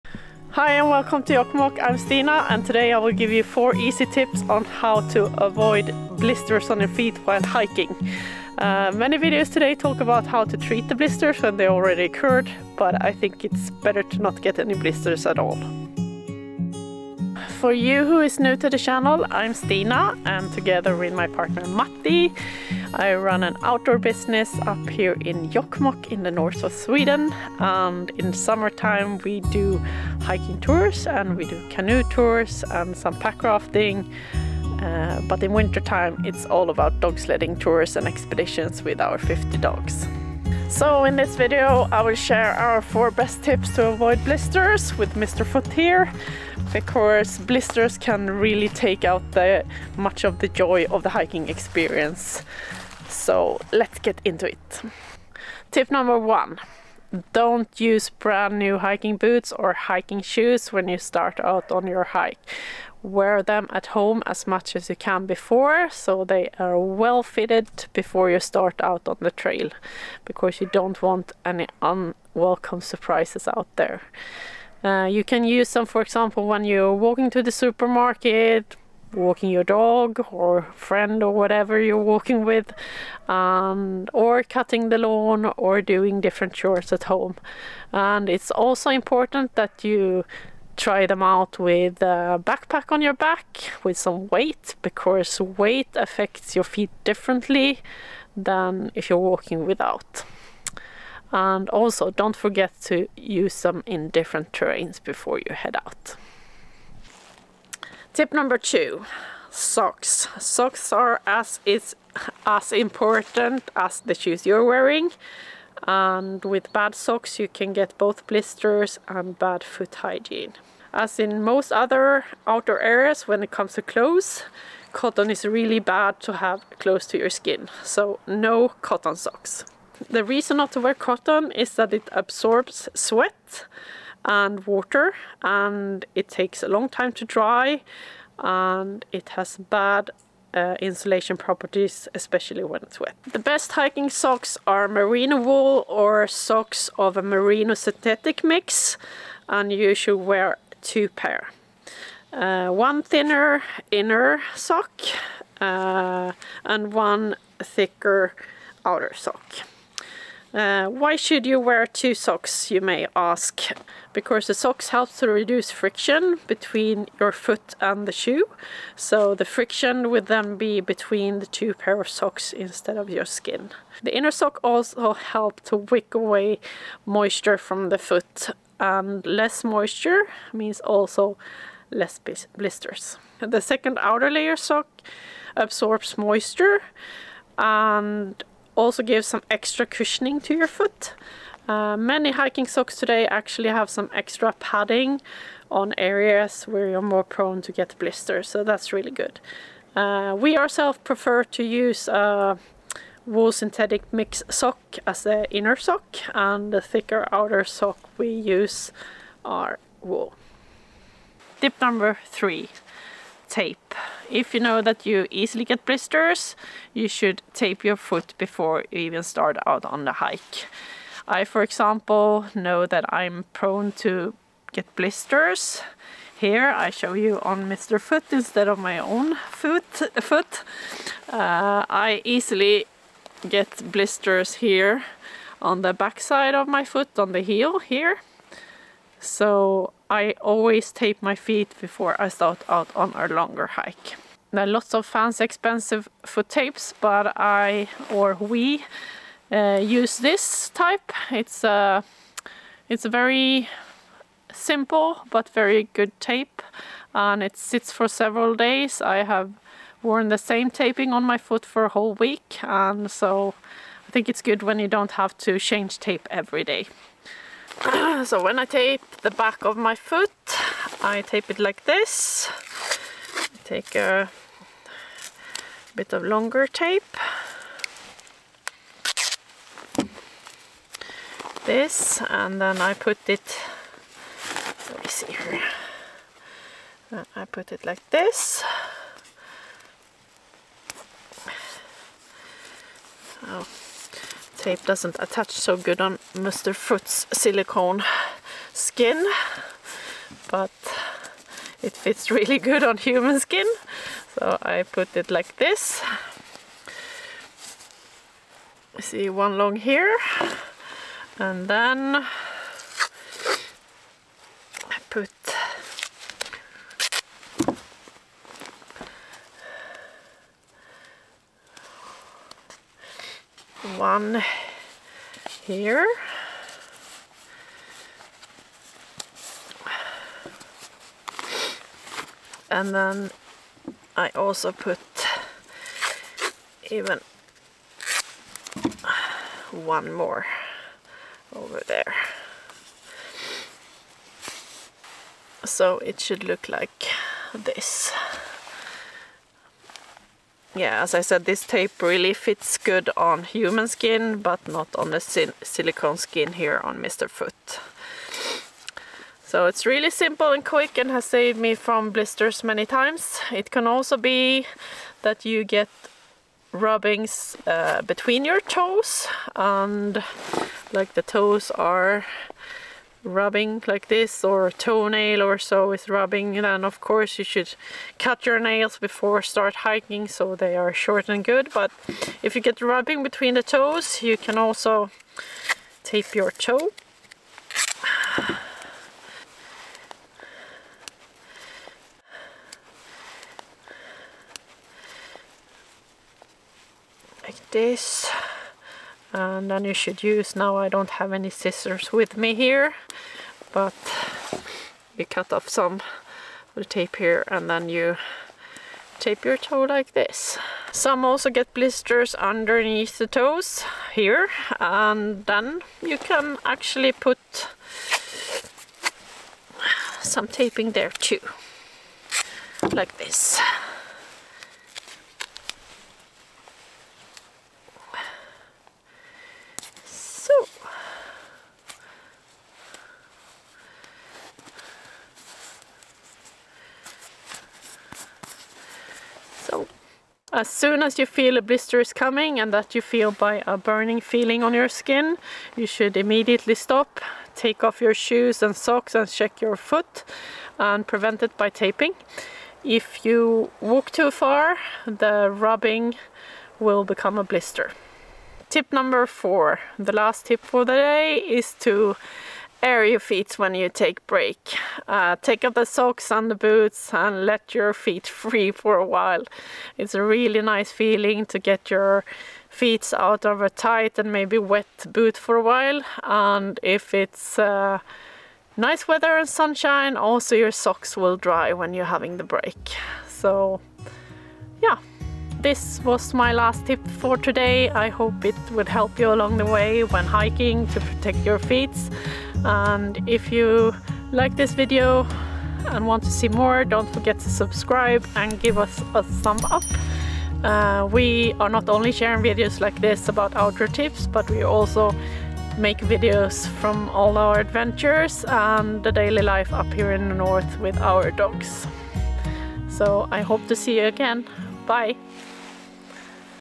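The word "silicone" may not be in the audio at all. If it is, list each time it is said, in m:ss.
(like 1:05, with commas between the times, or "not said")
4:57, 5:55.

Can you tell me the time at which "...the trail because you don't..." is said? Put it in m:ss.
1:09.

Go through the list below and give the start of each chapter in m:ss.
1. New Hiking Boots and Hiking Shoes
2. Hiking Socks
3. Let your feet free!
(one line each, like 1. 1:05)
1. 0:55
2. 1:47
3. 7:38.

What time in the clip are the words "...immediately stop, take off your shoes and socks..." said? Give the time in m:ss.
7:26.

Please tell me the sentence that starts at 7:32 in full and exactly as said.
If you walk too far, the rubbing will become a blister.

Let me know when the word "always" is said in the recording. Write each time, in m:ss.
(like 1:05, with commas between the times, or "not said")
4:00.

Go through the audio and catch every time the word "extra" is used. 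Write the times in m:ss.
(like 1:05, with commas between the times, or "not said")
3:09, 3:14.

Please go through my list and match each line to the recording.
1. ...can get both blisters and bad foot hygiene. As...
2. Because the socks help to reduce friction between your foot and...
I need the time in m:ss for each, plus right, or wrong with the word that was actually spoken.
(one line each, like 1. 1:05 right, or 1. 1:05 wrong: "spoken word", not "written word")
1. 1:57 right
2. 2:44 right.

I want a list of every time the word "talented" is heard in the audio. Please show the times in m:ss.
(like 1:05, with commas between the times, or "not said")
not said.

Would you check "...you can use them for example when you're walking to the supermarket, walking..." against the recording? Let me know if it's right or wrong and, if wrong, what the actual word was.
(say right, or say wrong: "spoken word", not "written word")
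right.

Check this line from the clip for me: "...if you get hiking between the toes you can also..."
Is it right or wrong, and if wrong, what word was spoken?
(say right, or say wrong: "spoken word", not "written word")
wrong: "rubbing", not "hiking".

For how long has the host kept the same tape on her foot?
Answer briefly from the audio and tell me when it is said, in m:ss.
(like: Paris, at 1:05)
A whole week, at 4:21.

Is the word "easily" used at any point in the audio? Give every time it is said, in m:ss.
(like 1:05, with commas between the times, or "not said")
3:35, 3:52.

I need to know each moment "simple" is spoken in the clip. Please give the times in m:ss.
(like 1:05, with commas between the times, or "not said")
4:14, 6:00.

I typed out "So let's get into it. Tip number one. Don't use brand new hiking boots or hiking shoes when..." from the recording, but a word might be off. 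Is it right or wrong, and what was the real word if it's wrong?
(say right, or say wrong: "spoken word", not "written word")
right.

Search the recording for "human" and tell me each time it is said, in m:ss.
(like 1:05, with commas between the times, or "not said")
5:02, 5:53.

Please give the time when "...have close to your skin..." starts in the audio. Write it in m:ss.
2:06.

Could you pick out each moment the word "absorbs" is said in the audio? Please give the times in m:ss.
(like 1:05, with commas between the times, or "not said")
2:12, 3:05.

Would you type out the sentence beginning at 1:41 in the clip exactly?
And also don't forget to use them in different terrains before you head out.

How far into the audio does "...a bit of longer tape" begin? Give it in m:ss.
4:33.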